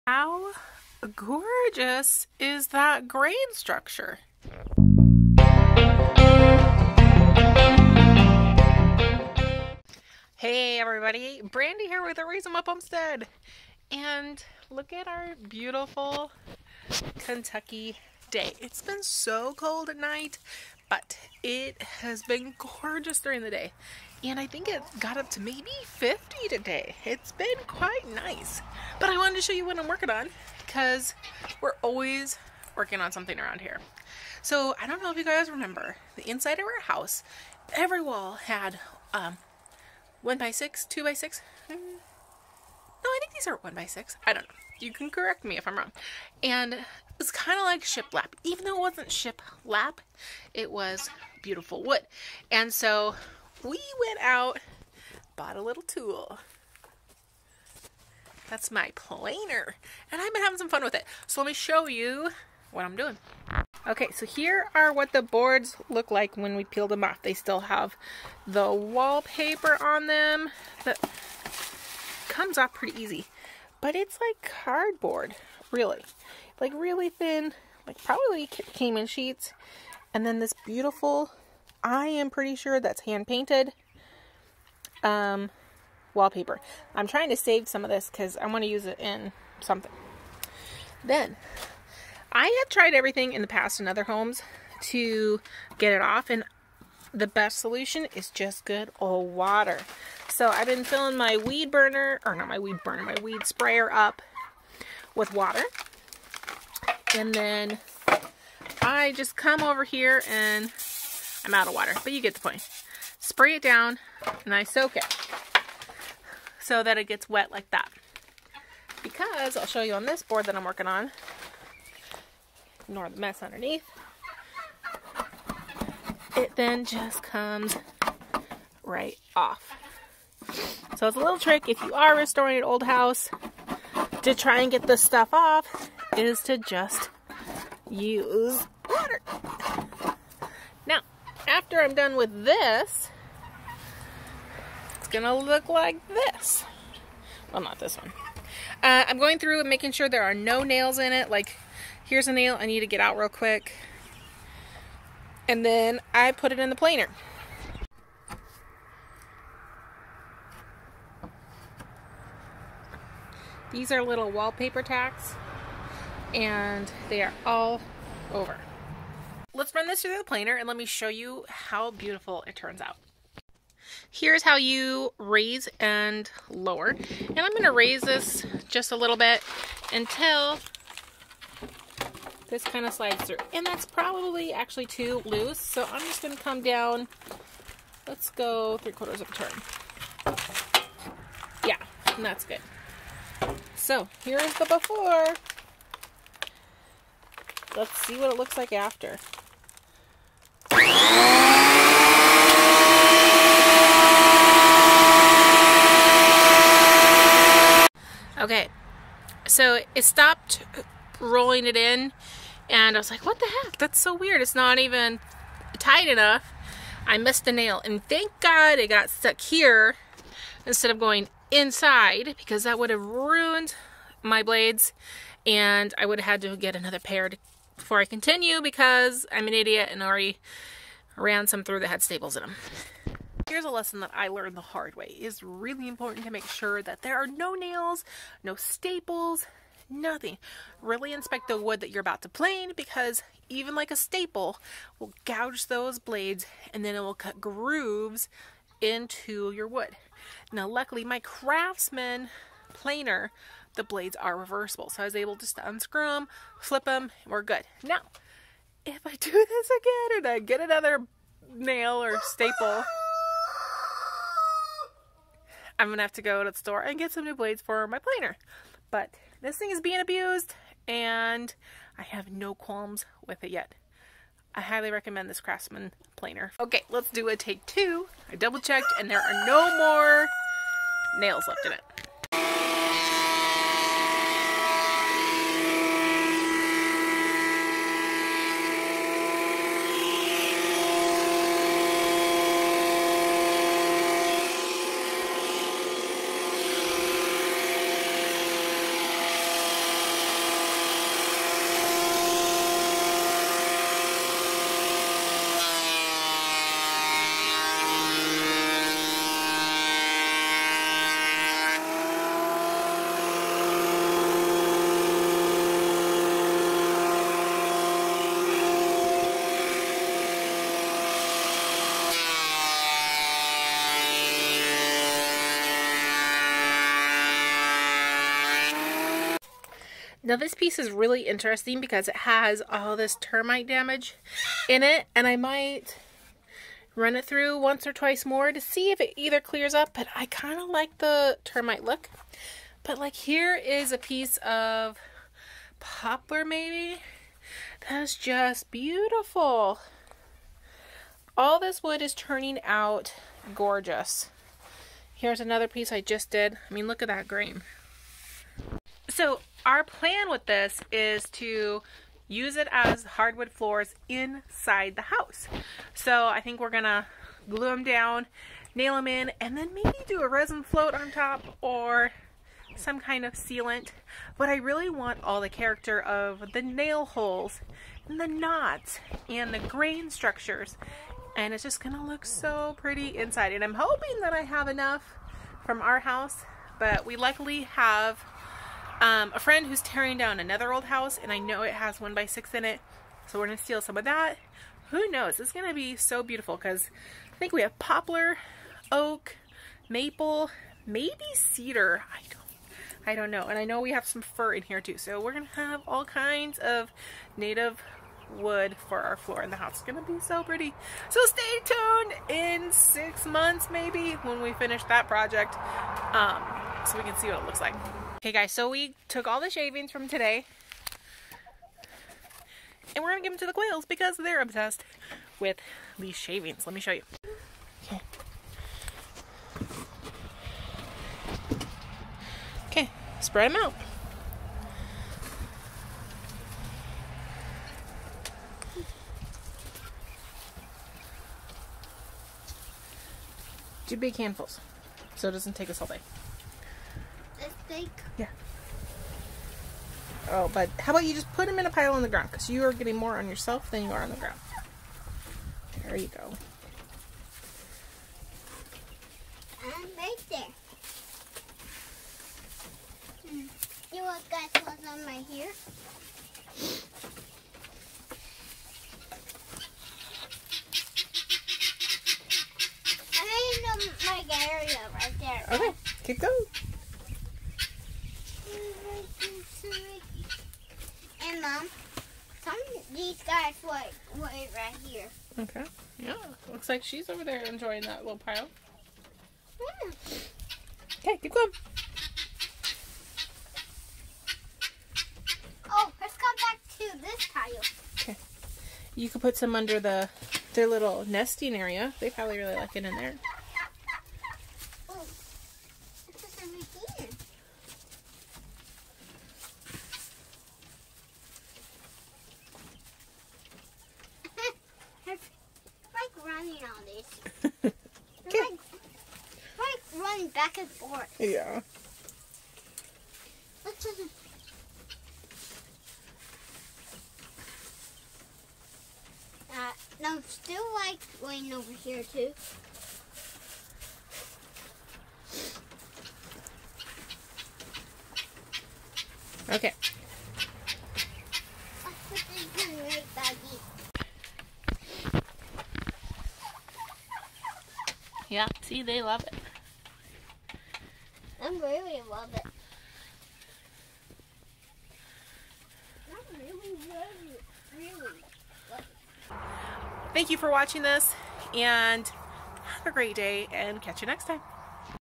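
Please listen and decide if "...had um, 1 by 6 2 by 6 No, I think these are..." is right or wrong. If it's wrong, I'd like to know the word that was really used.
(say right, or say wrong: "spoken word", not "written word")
right.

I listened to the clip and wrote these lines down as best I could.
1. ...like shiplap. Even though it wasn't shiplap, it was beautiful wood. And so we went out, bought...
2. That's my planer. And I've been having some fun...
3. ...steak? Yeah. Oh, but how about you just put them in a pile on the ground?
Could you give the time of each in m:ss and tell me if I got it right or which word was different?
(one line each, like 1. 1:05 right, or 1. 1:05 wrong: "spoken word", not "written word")
1. 0:47 right
2. 0:58 right
3. 7:27 right.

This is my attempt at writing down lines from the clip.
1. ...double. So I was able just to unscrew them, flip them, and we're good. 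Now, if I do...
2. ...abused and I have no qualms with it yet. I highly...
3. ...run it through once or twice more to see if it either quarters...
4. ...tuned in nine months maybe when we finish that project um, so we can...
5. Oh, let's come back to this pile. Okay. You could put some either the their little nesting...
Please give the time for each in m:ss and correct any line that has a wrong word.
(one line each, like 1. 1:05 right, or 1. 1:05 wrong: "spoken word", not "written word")
1. 4:14 wrong: "reversible", not "double"
2. 4:29 right
3. 5:36 wrong: "clears", not "quarters"
4. 6:51 wrong: "six", not "nine"
5. 8:15 wrong: "under", not "either".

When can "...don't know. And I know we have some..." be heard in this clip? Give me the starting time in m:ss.
6:43.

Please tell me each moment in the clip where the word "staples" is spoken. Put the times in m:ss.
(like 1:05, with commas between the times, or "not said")
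3:52, 3:58, 4:03, 4:22.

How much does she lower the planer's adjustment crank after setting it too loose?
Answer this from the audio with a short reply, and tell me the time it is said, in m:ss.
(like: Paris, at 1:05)
three quarters of a turn, at 3:08.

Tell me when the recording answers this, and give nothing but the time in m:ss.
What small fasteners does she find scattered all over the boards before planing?
2:44.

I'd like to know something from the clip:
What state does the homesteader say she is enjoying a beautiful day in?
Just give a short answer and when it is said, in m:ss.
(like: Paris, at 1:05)
Kentucky, at 0:17.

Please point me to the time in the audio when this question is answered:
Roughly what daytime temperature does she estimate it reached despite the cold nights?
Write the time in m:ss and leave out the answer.
0:25.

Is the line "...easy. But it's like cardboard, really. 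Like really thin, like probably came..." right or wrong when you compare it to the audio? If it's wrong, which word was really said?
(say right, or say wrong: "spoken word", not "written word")
right.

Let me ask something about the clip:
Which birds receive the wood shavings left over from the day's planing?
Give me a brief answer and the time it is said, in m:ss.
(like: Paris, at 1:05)
quails, at 7:03.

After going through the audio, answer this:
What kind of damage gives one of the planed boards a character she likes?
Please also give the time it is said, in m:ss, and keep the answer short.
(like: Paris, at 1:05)
termite damage, at 5:33.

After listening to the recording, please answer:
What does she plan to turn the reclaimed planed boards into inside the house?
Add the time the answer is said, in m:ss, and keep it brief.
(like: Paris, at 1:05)
hardwood floors, at 6:03.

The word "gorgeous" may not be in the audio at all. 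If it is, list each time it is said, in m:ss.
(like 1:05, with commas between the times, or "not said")
0:01, 0:22, 5:53.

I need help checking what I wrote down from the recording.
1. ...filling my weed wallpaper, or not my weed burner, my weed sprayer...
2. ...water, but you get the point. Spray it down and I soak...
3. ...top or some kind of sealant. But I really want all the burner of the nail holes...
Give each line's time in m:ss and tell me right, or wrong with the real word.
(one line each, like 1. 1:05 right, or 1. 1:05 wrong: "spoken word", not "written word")
1. 1:40 wrong: "burner", not "wallpaper"
2. 1:51 right
3. 6:11 wrong: "character", not "burner".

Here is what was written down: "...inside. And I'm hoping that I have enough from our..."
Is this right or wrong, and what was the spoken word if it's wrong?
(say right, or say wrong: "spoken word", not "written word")
right.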